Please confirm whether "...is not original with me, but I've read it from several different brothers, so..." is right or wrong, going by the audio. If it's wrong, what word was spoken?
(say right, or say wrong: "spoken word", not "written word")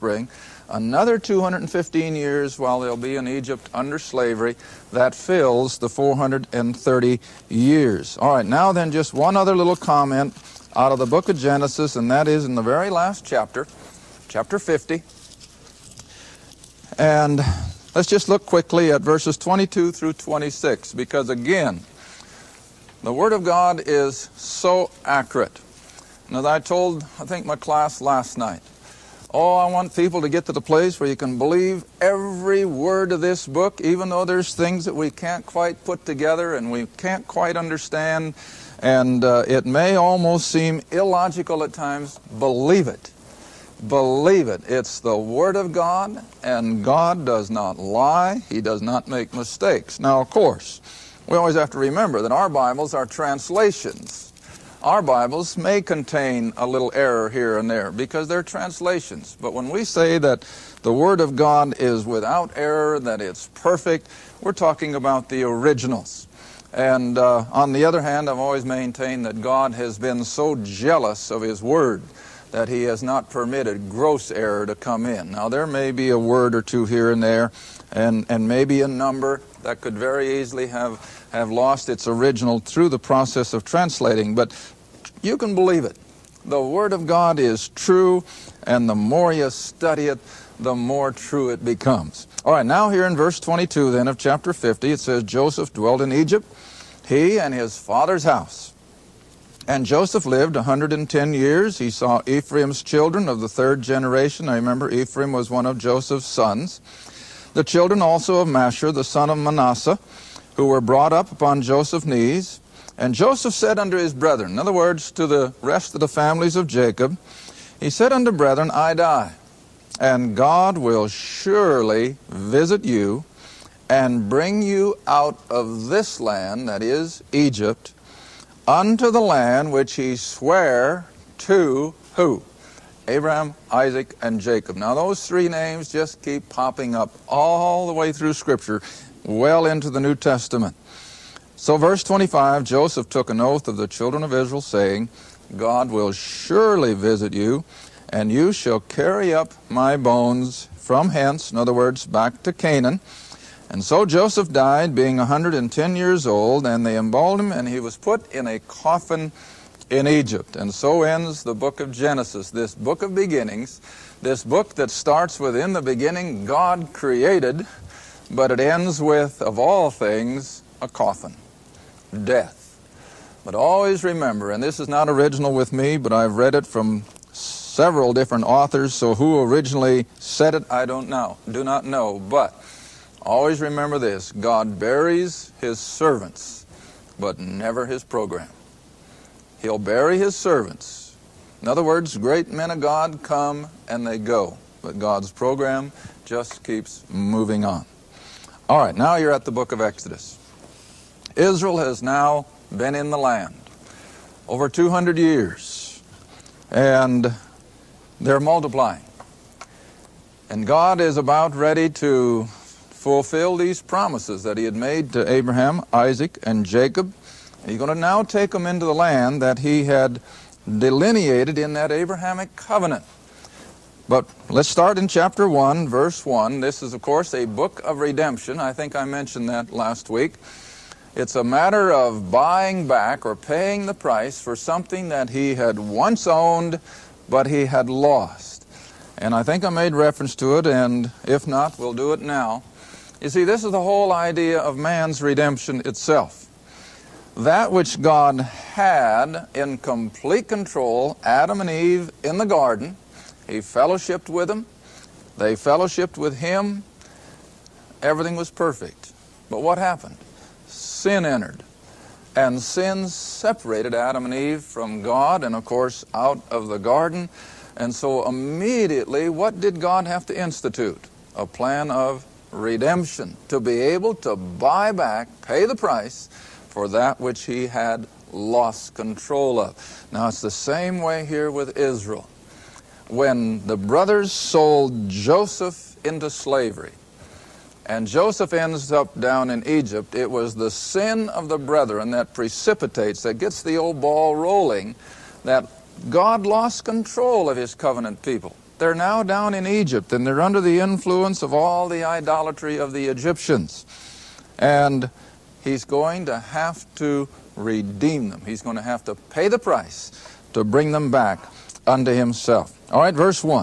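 wrong: "authors", not "brothers".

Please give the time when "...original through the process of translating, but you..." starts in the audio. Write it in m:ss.
1:22.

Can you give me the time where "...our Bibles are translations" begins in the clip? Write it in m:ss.
0:52.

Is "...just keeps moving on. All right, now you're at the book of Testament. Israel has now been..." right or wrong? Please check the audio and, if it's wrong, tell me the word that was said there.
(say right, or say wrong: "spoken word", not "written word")
wrong: "Exodus", not "Testament".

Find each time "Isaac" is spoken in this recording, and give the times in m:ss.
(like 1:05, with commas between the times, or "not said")
2:13, 3:35.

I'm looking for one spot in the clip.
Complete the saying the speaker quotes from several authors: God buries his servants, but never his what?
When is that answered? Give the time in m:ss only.
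3:07.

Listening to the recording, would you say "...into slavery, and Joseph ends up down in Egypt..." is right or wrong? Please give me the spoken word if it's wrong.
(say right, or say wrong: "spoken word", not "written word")
right.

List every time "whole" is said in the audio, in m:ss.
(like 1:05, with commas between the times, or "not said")
4:03.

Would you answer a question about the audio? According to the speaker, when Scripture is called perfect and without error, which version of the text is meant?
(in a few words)
The originals.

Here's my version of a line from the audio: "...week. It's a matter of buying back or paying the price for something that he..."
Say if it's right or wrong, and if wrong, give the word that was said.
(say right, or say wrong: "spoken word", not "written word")
right.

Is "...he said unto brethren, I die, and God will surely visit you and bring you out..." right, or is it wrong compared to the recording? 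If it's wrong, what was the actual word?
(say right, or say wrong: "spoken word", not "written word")
right.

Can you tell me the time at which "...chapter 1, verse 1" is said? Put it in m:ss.
3:45.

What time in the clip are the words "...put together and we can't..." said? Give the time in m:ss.
0:35.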